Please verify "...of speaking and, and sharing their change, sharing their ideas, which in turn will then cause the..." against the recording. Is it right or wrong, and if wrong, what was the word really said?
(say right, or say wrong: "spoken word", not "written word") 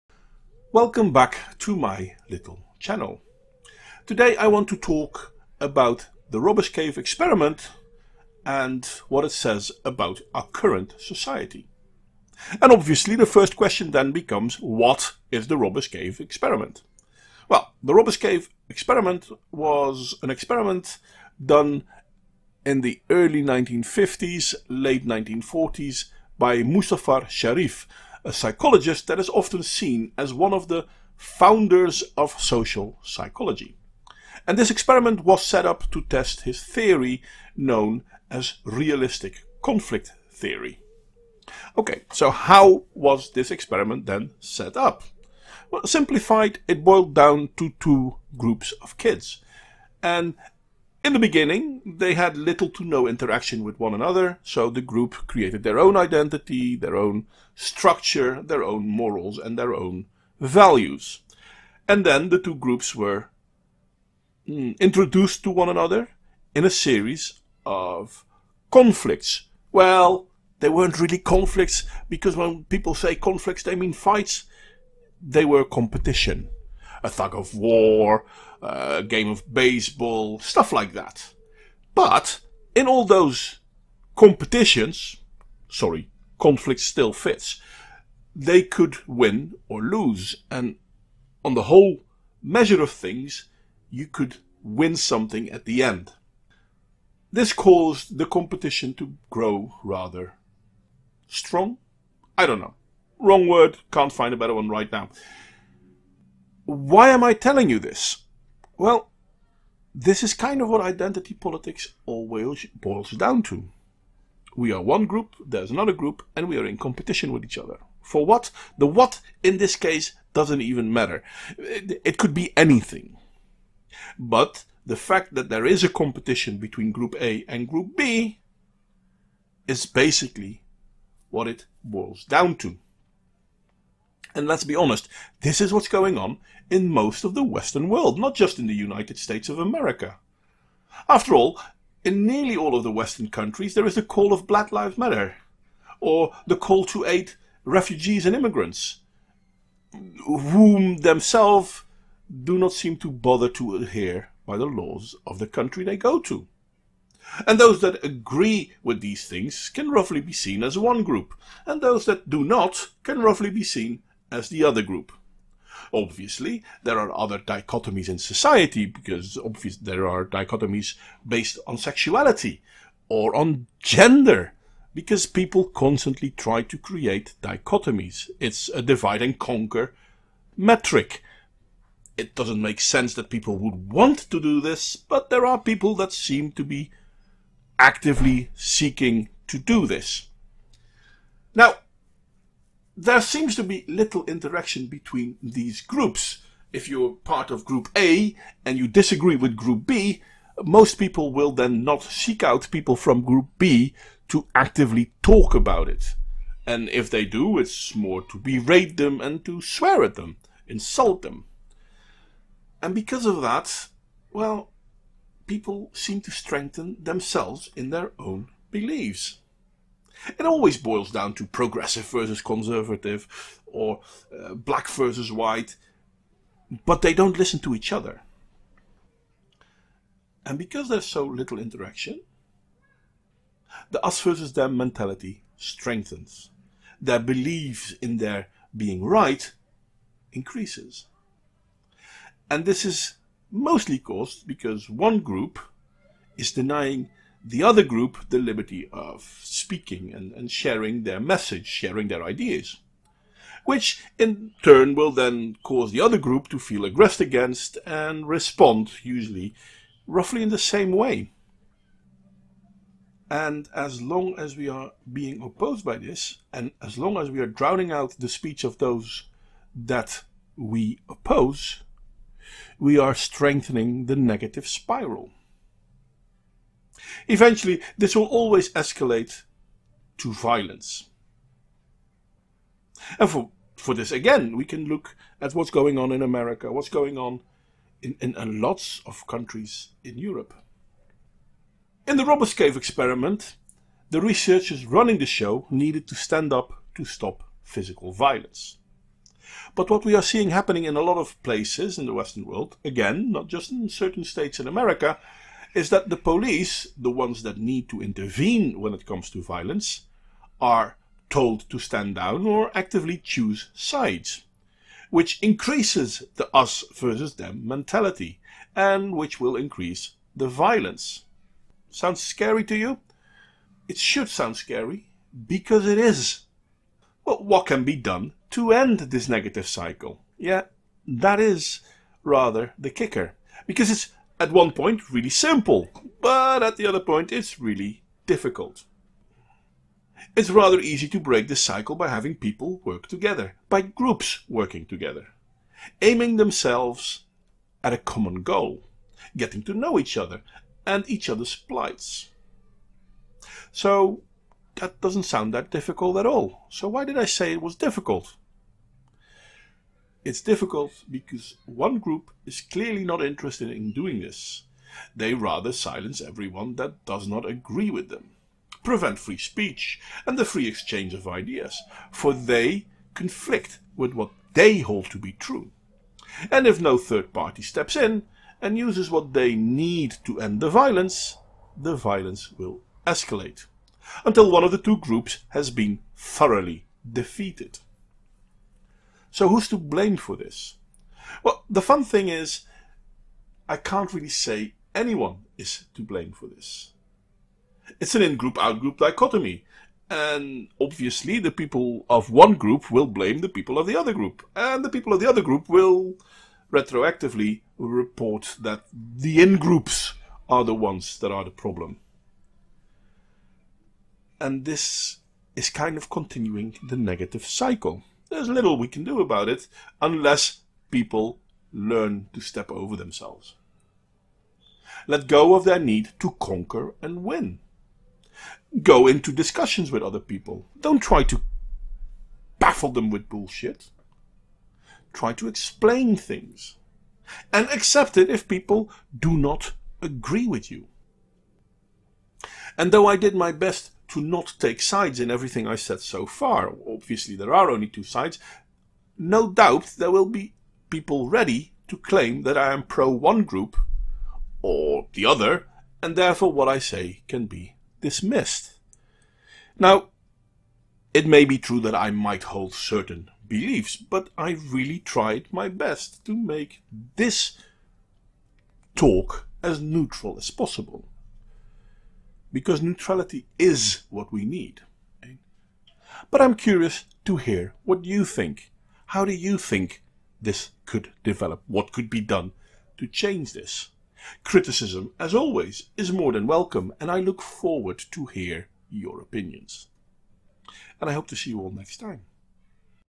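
wrong: "message", not "change".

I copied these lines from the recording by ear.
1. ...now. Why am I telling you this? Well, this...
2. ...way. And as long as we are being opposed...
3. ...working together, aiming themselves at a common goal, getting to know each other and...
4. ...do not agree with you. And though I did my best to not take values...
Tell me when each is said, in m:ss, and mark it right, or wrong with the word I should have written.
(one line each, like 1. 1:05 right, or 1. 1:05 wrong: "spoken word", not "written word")
1. 1:44 right
2. 4:20 right
3. 5:44 right
4. 7:19 wrong: "sides", not "values".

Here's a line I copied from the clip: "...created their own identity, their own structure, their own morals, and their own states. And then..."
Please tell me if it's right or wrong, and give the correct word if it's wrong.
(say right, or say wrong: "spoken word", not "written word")
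wrong: "values", not "states".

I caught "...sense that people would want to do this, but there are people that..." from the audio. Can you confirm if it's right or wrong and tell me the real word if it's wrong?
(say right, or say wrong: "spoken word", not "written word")
right.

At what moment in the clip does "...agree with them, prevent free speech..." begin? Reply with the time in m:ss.
6:07.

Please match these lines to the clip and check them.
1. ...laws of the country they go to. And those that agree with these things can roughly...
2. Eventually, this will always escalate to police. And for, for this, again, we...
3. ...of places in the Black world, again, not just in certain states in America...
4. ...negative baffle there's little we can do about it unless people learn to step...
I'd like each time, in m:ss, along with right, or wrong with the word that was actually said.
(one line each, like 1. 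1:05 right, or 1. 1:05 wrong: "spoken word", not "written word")
1. 2:34 right
2. 4:37 wrong: "violence", not "police"
3. 5:01 wrong: "Western", not "Black"
4. 6:56 wrong: "cycle", not "baffle".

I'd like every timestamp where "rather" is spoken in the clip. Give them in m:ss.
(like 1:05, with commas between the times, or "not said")
1:39, 5:32, 5:40, 6:05.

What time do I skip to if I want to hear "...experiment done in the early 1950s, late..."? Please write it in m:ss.
0:20.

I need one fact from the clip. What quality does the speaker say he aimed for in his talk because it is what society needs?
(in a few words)
Neutrality.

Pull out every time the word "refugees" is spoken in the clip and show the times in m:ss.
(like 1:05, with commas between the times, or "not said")
2:27.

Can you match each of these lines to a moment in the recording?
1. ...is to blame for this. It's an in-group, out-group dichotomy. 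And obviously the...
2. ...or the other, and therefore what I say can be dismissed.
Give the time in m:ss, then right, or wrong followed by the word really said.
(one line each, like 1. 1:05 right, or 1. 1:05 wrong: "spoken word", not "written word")
1. 6:35 right
2. 7:34 right.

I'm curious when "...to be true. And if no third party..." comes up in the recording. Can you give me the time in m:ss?
6:15.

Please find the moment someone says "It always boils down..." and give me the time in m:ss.
3:40.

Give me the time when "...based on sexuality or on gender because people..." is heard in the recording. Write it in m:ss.
2:51.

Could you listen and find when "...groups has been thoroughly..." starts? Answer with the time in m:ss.
6:24.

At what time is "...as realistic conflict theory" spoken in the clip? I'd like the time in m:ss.
0:38.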